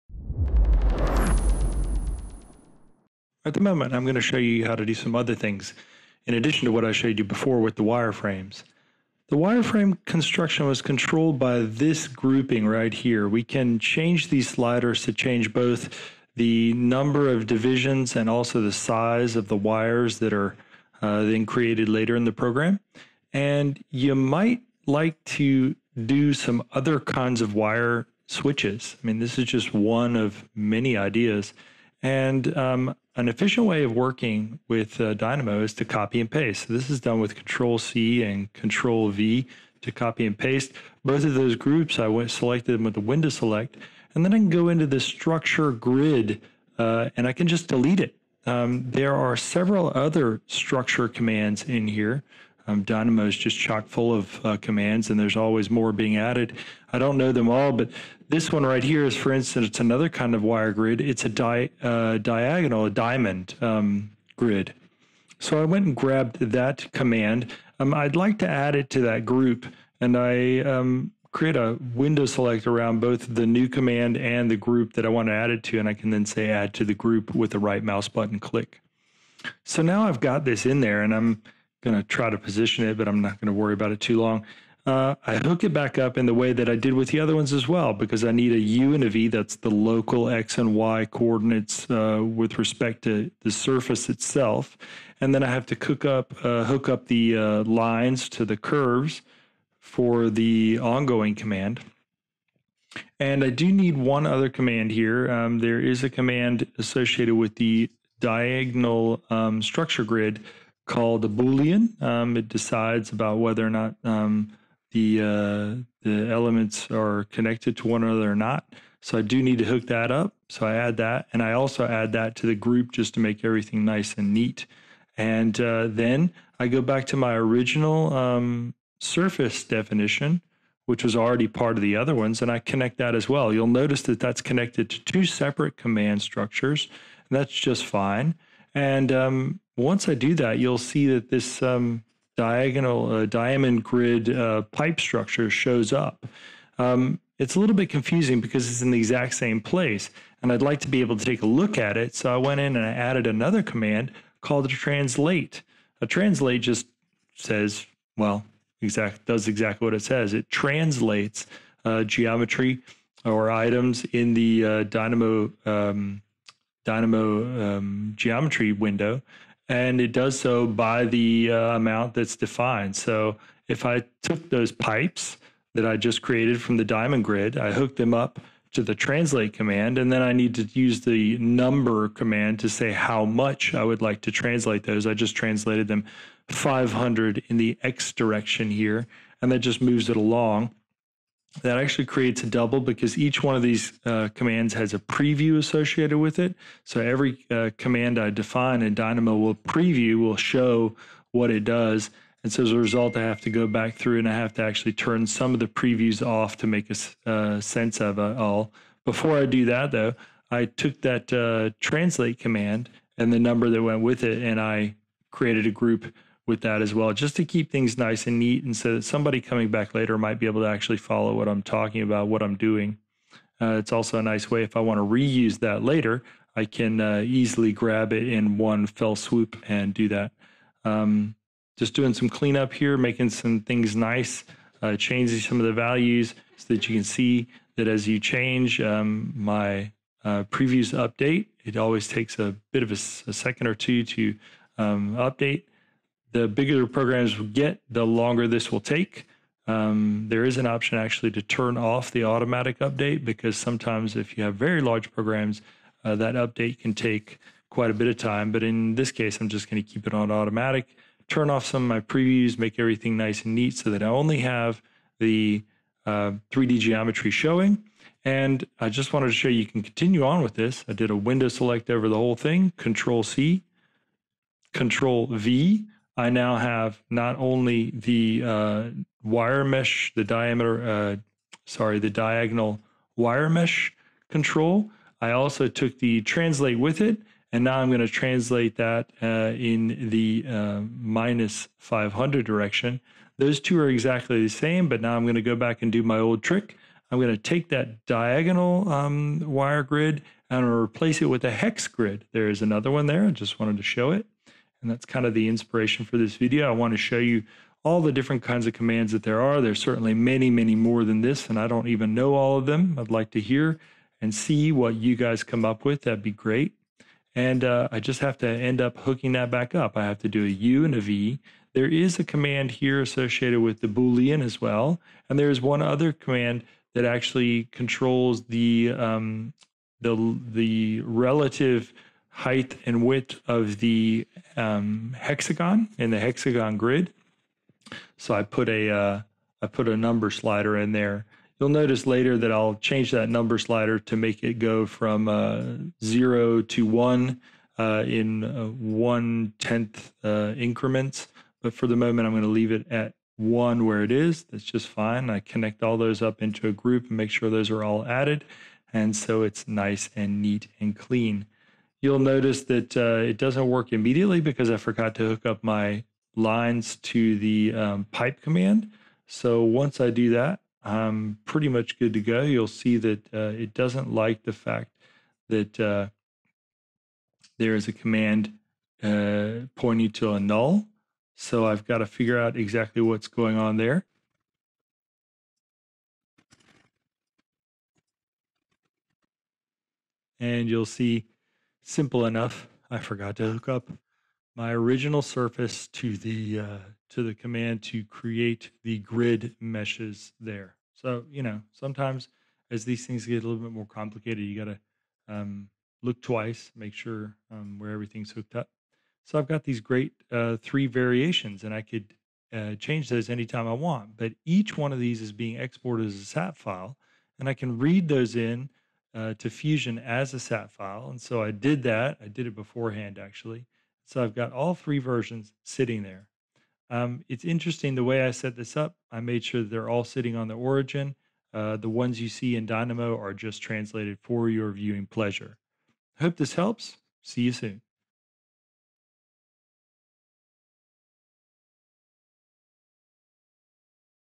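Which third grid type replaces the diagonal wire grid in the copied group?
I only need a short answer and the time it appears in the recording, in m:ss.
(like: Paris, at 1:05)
hex grid, at 5:01.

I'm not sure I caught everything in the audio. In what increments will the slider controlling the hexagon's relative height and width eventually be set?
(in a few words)
one tenth.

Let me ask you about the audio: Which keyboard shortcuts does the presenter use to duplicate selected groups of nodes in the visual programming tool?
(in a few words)
Control C and Control V.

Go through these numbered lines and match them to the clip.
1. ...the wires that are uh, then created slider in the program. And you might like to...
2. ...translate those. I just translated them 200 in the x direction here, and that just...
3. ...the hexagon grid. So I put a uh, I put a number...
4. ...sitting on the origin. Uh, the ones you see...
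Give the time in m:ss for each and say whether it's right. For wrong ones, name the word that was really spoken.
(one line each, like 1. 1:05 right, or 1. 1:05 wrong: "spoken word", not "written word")
1. 0:19 wrong: "later", not "slider"
2. 3:04 wrong: "500", not "200"
3. 5:36 right
4. 7:10 right.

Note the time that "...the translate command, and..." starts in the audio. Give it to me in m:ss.
2:58.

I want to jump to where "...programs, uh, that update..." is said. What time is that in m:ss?
4:15.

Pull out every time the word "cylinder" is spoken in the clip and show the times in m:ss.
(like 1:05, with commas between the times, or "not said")
not said.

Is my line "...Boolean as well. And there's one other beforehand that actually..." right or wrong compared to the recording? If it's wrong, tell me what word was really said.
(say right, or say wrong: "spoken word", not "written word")
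wrong: "command", not "beforehand".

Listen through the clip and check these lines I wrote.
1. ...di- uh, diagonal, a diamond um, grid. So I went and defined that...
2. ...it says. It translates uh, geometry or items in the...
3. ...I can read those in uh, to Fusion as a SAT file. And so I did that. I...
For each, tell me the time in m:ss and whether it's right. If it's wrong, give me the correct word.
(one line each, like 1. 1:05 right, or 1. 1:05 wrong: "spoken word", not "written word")
1. 1:01 wrong: "grabbed", not "defined"
2. 2:39 right
3. 6:57 right.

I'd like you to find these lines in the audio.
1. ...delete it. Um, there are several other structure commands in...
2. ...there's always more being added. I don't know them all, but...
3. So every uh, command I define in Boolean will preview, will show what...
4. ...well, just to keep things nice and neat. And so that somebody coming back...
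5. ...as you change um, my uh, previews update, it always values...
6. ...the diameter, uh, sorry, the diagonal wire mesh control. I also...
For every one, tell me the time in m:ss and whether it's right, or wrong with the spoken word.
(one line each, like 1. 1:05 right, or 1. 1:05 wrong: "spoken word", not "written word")
1. 0:47 right
2. 0:55 right
3. 3:16 wrong: "Dynamo", not "Boolean"
4. 3:36 right
5. 3:57 wrong: "takes", not "values"
6. 4:40 right.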